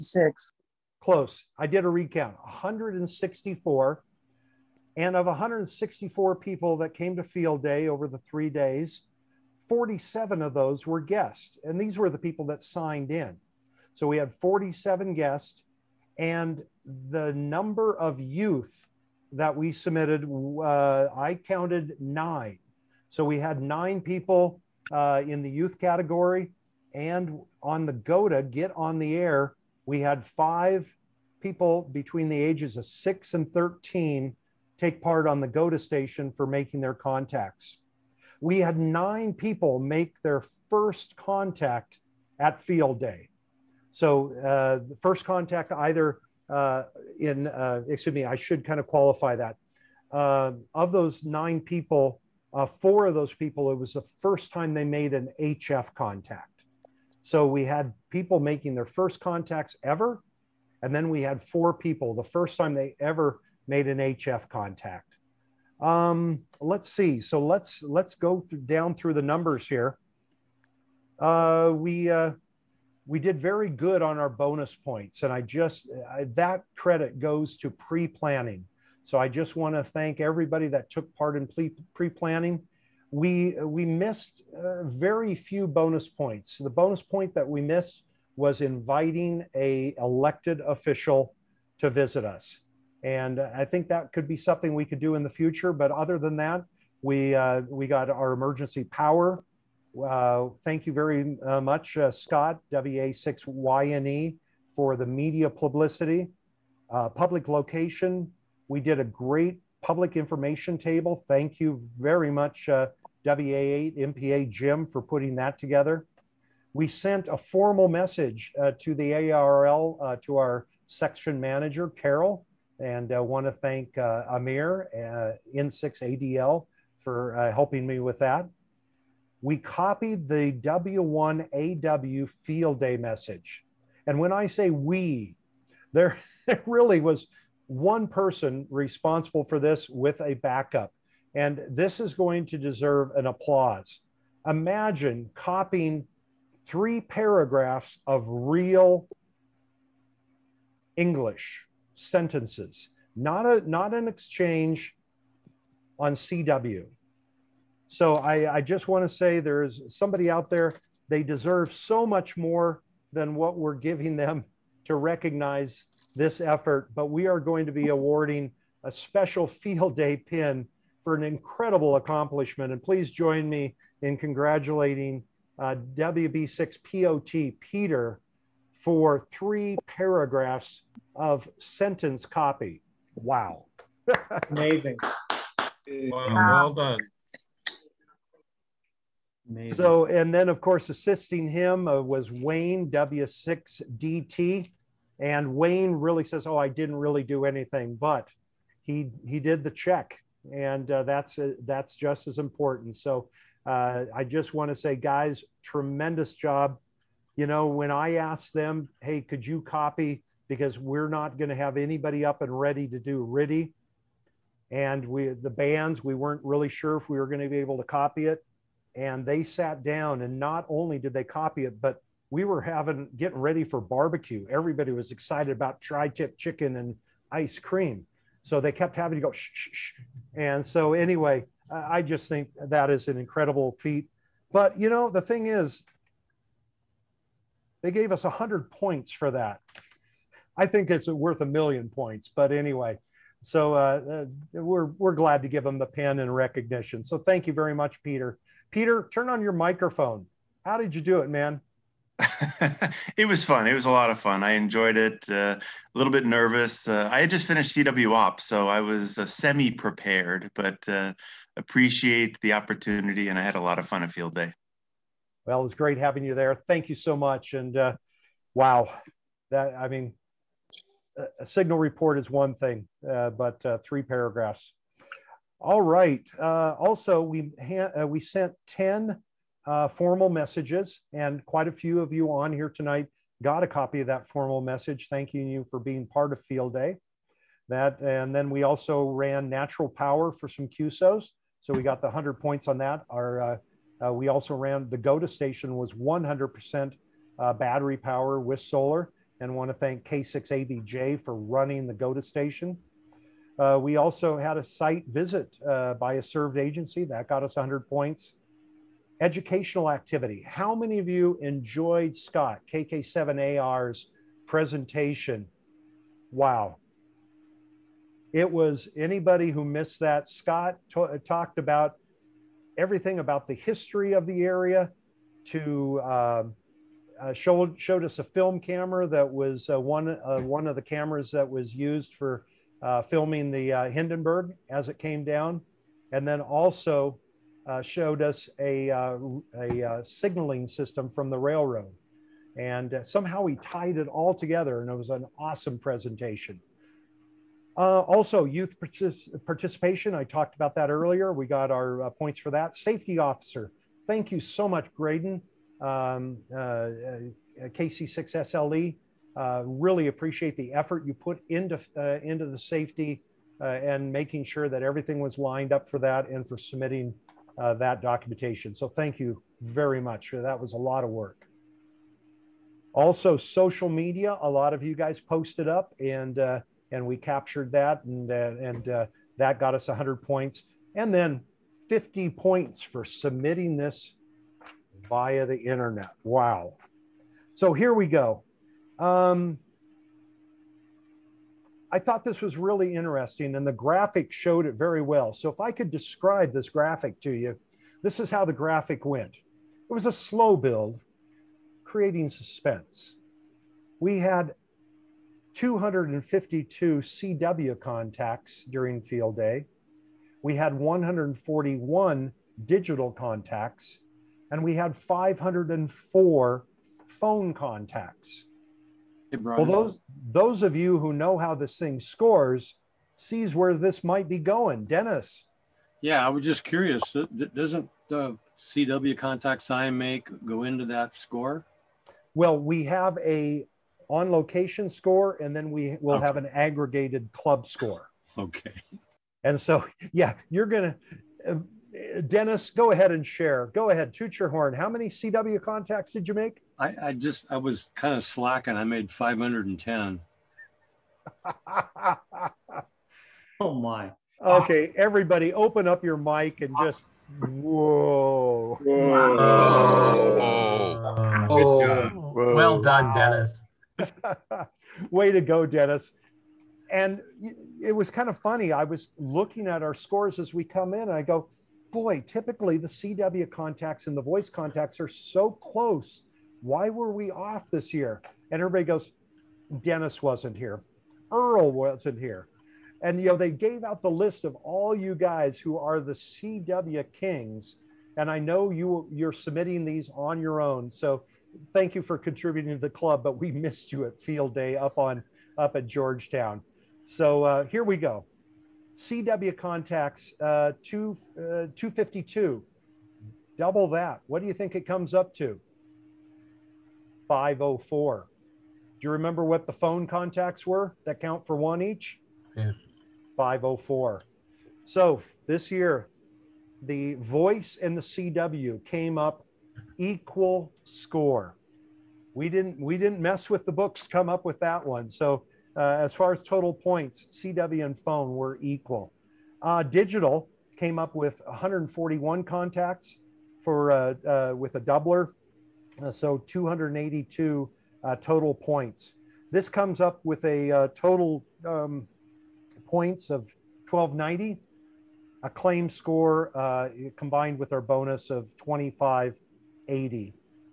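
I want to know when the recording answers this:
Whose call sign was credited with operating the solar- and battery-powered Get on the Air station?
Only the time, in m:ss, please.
5:00.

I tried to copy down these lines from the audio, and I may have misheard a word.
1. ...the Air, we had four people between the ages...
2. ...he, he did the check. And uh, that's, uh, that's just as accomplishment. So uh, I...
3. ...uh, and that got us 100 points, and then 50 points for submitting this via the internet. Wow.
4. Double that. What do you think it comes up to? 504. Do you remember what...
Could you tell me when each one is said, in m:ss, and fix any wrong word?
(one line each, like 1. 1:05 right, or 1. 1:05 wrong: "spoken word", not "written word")
1. 0:28 wrong: "five", not "four"
2. 3:18 wrong: "important", not "accomplishment"
3. 6:18 right
4. 8:23 right.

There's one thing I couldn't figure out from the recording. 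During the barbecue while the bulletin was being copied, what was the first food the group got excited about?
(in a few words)
tri-tip.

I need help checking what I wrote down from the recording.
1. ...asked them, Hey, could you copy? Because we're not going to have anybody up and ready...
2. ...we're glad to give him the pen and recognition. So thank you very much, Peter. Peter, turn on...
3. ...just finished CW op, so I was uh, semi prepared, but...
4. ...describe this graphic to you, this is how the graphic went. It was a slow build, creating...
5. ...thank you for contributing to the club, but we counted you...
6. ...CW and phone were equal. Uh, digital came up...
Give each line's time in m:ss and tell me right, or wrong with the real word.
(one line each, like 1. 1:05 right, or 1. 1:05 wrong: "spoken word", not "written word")
1. 3:28 right
2. 4:04 right
3. 4:17 right
4. 6:35 right
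5. 8:11 wrong: "missed", not "counted"
6. 8:47 right.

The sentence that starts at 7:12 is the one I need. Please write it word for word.
Well, we have a on location score, and then we will okay.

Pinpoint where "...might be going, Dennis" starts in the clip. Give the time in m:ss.
7:04.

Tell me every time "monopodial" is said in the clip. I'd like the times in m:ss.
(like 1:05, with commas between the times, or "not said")
not said.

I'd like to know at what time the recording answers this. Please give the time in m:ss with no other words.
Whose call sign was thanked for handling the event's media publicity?
1:42.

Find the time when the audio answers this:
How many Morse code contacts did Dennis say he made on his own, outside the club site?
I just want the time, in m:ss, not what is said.
7:29.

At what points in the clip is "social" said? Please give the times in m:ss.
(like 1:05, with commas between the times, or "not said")
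6:13.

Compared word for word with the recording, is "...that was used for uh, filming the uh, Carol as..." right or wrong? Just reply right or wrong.
wrong.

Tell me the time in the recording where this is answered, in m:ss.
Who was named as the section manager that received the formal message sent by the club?
2:01.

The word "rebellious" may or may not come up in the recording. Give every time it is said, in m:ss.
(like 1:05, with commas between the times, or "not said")
not said.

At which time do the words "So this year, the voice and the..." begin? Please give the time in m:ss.
8:34.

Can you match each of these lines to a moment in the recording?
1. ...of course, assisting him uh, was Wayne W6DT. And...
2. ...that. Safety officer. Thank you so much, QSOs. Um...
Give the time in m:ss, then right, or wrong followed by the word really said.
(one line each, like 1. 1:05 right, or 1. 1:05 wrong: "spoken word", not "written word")
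1. 3:10 right
2. 5:52 wrong: "Graydon", not "QSOs".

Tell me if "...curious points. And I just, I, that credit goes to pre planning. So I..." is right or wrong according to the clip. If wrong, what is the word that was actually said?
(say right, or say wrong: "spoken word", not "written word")
wrong: "bonus", not "curious".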